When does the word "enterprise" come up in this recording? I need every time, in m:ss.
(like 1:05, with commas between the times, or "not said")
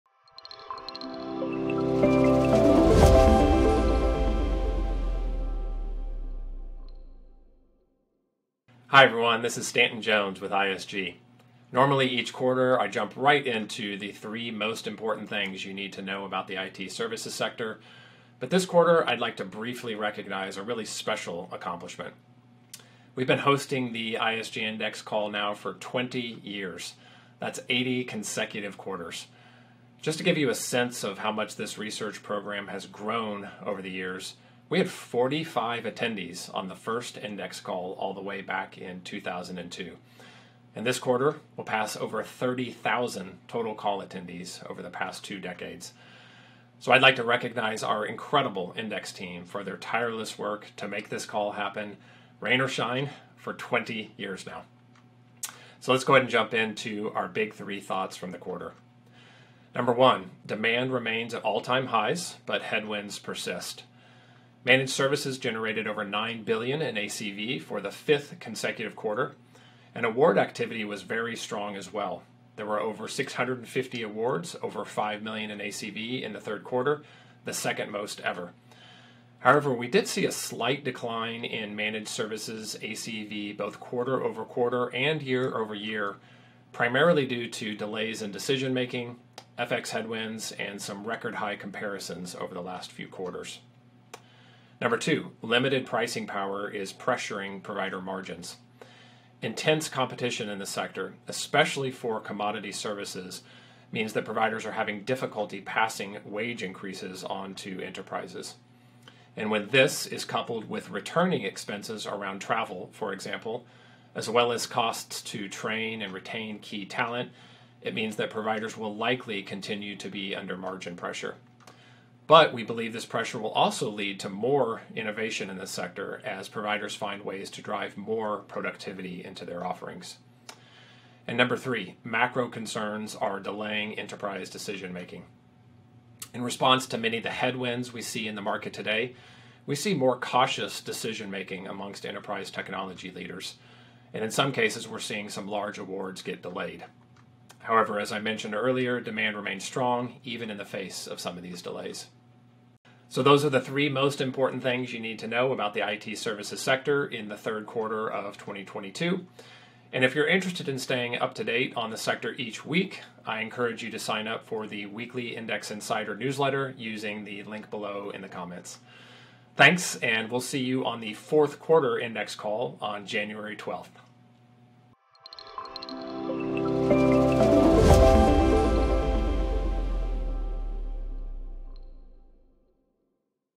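1:47, 2:13, 2:22.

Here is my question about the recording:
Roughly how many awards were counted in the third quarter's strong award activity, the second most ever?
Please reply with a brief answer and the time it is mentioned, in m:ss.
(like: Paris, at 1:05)
over 650, at 1:12.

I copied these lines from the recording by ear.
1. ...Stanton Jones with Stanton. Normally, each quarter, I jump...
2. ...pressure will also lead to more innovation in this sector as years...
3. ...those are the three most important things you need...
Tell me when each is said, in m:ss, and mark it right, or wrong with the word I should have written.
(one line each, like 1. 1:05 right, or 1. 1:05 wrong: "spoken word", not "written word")
1. 0:09 wrong: "ISG", not "Stanton"
2. 2:03 wrong: "providers", not "years"
3. 2:33 right.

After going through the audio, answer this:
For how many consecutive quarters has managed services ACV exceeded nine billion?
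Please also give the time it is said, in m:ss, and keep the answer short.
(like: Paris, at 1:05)
fifth, at 1:07.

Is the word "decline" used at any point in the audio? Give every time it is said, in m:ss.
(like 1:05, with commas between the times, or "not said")
1:20.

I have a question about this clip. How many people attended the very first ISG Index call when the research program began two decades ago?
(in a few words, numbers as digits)
45.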